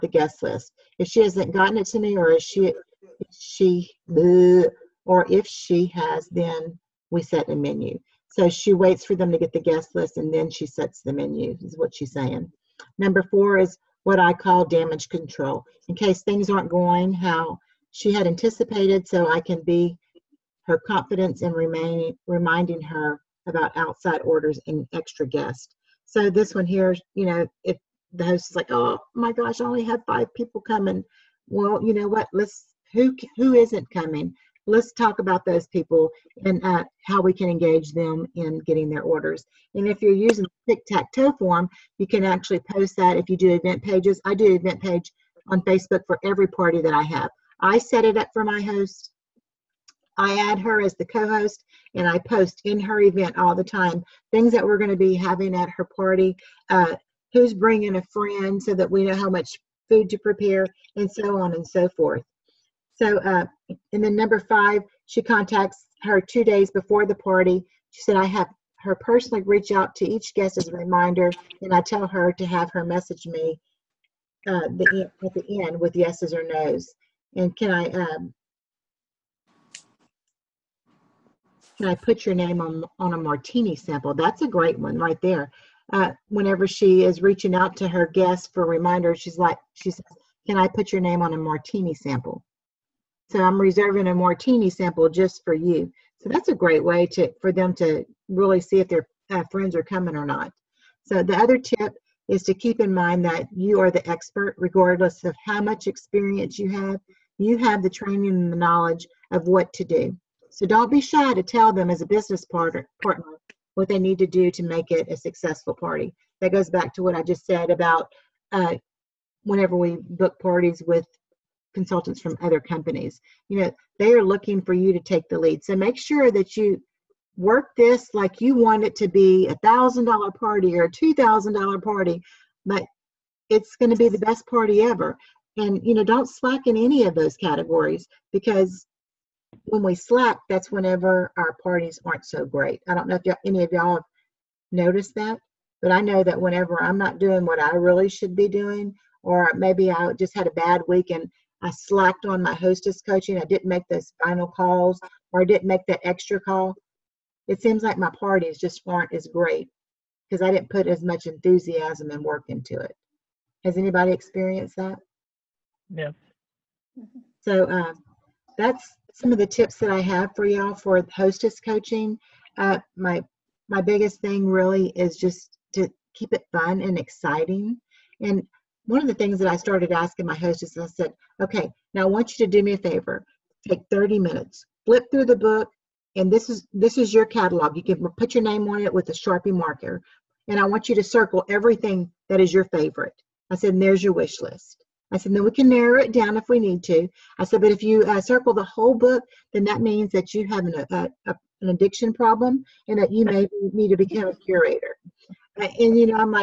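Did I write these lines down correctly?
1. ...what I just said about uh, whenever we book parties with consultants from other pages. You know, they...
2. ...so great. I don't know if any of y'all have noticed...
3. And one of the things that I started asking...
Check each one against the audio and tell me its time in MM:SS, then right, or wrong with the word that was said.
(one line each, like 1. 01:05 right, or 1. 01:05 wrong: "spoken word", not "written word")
1. 01:57 wrong: "companies", not "pages"
2. 02:22 right
3. 02:58 right.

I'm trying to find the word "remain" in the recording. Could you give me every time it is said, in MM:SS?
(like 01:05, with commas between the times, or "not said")
00:21.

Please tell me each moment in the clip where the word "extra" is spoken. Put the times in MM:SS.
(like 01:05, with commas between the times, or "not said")
00:24, 02:36.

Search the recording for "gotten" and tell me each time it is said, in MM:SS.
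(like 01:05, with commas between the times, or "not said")
00:01.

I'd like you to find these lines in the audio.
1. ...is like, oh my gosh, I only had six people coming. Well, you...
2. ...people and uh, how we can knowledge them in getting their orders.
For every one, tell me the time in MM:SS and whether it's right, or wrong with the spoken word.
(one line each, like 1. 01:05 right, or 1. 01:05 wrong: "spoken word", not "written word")
1. 00:28 wrong: "five", not "six"
2. 00:35 wrong: "engage", not "knowledge".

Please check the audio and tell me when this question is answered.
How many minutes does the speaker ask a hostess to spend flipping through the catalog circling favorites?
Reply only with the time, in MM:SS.
03:03.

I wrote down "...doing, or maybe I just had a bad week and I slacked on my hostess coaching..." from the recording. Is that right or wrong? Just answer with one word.
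right.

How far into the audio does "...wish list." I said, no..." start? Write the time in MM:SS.
03:14.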